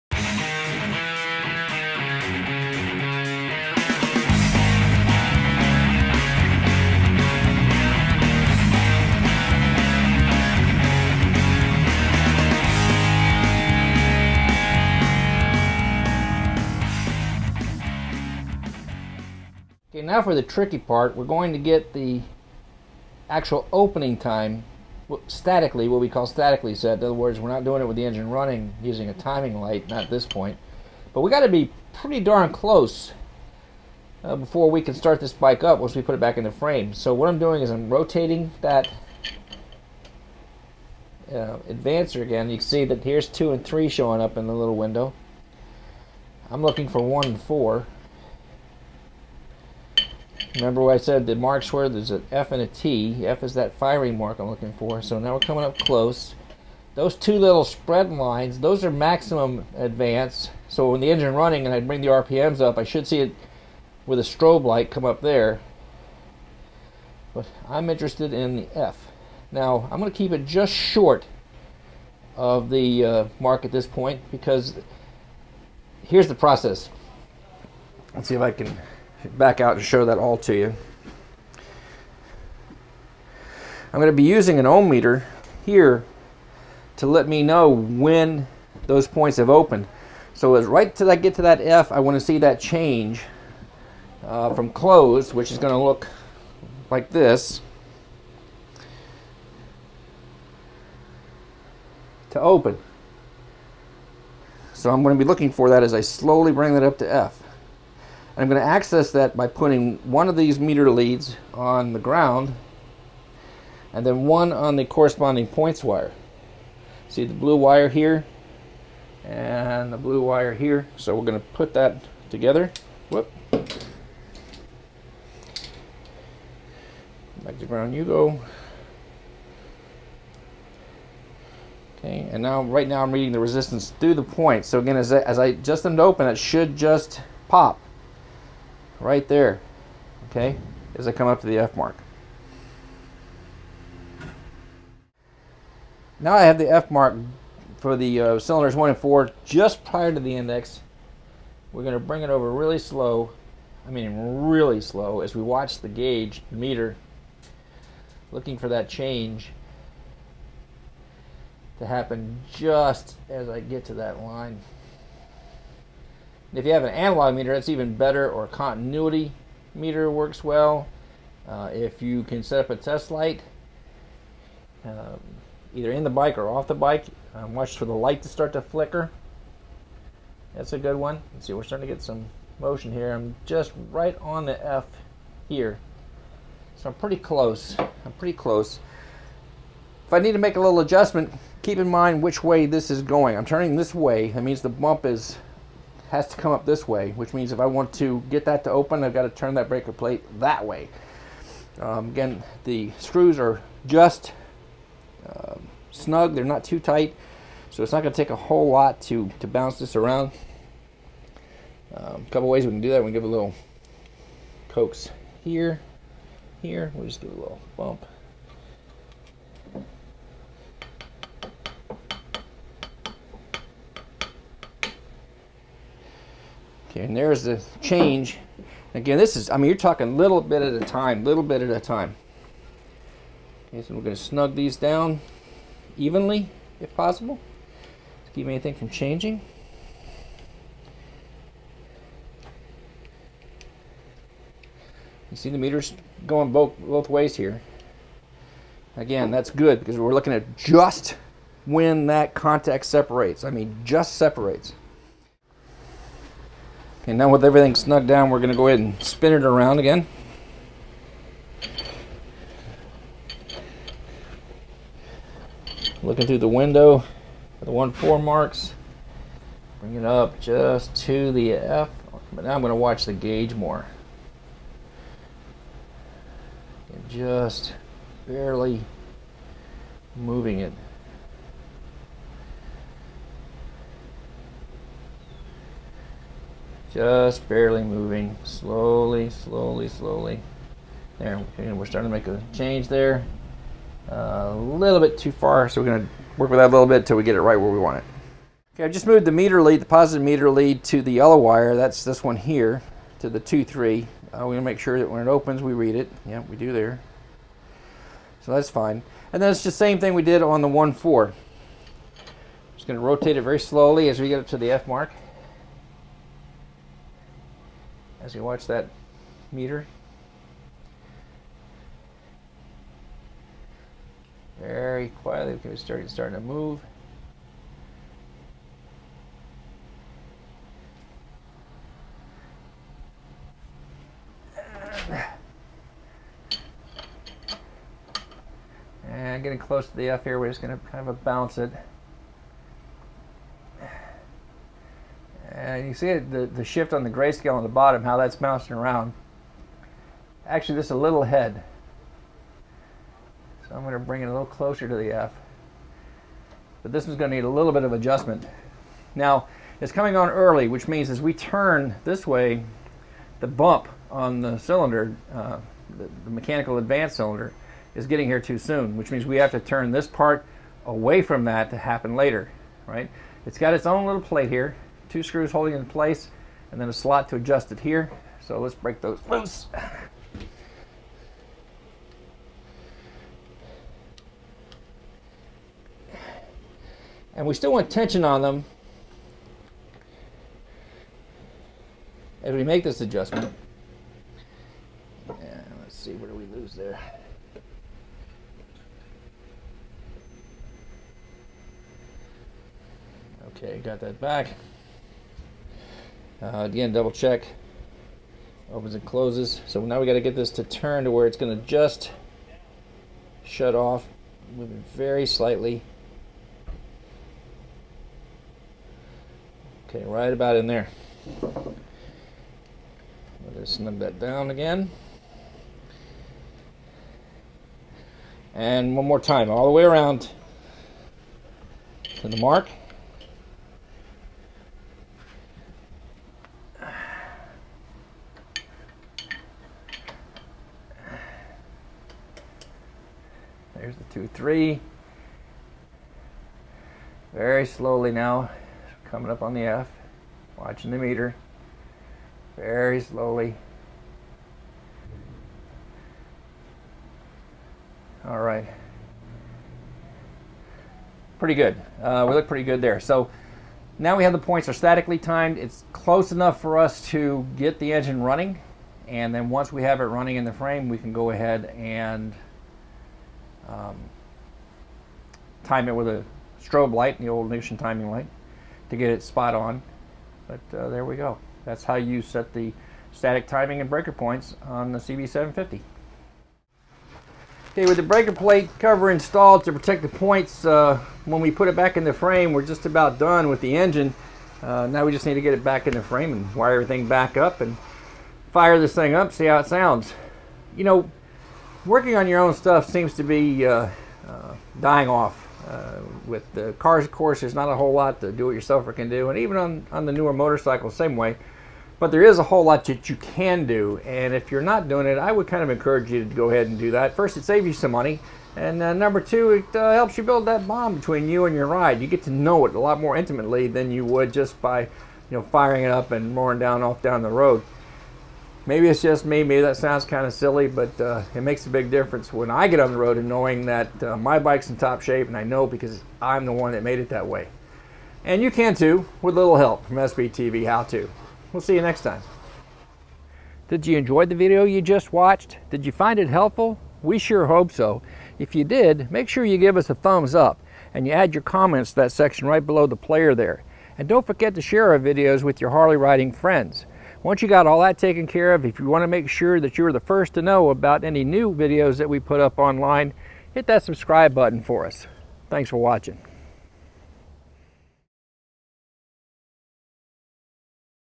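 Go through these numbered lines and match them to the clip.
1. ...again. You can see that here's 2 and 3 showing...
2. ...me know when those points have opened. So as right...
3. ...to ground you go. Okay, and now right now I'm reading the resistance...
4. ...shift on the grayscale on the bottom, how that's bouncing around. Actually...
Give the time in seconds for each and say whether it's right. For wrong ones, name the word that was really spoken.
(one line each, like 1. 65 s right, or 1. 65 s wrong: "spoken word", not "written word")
1. 42 s right
2. 87 s right
3. 127 s right
4. 346 s right.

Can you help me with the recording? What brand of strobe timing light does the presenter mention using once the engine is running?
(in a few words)
Nixon.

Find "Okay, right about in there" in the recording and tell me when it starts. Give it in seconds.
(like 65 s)
419 s.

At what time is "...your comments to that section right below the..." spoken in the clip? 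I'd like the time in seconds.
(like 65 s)
551 s.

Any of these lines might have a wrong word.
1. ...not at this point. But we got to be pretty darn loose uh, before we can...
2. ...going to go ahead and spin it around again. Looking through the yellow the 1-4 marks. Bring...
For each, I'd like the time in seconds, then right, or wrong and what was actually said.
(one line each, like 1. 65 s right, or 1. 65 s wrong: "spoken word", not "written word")
1. 29 s wrong: "close", not "loose"
2. 258 s wrong: "window", not "yellow".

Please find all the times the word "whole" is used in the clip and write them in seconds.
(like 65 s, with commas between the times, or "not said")
208 s, 507 s, 512 s.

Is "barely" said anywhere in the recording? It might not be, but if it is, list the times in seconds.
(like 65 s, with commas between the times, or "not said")
278 s, 287 s.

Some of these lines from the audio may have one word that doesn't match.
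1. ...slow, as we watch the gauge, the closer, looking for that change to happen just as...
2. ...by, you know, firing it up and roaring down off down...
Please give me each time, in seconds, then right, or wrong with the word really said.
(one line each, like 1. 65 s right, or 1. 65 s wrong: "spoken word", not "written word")
1. 154 s wrong: "meter", not "closer"
2. 524 s right.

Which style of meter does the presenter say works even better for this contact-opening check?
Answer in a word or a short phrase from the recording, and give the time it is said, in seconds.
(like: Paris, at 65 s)
Analog meter, at 166 s.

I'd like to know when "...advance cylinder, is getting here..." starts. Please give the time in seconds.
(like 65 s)
366 s.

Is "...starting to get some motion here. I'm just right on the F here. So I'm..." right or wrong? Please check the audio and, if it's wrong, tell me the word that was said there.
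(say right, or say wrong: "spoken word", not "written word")
right.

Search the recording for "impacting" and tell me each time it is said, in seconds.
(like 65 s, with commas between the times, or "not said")
not said.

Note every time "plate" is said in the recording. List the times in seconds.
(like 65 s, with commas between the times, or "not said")
199 s, 374 s, 488 s.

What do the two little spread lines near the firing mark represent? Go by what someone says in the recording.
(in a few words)
Maximum advance.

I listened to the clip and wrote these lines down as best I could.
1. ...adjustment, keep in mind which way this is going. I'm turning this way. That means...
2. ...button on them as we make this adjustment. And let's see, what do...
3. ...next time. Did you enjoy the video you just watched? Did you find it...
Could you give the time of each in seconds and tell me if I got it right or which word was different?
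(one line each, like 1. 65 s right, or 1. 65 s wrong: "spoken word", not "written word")
1. 190 s right
2. 387 s wrong: "tension", not "button"
3. 541 s right.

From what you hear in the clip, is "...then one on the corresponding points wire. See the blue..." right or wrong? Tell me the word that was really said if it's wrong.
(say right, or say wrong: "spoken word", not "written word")
right.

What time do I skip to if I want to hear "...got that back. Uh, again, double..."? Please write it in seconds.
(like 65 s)
403 s.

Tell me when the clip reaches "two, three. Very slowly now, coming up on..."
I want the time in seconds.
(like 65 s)
444 s.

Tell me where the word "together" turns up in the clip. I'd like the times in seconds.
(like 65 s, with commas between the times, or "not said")
122 s.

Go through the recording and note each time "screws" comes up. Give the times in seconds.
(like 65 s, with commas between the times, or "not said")
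202 s, 375 s.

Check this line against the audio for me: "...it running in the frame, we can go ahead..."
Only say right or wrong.
right.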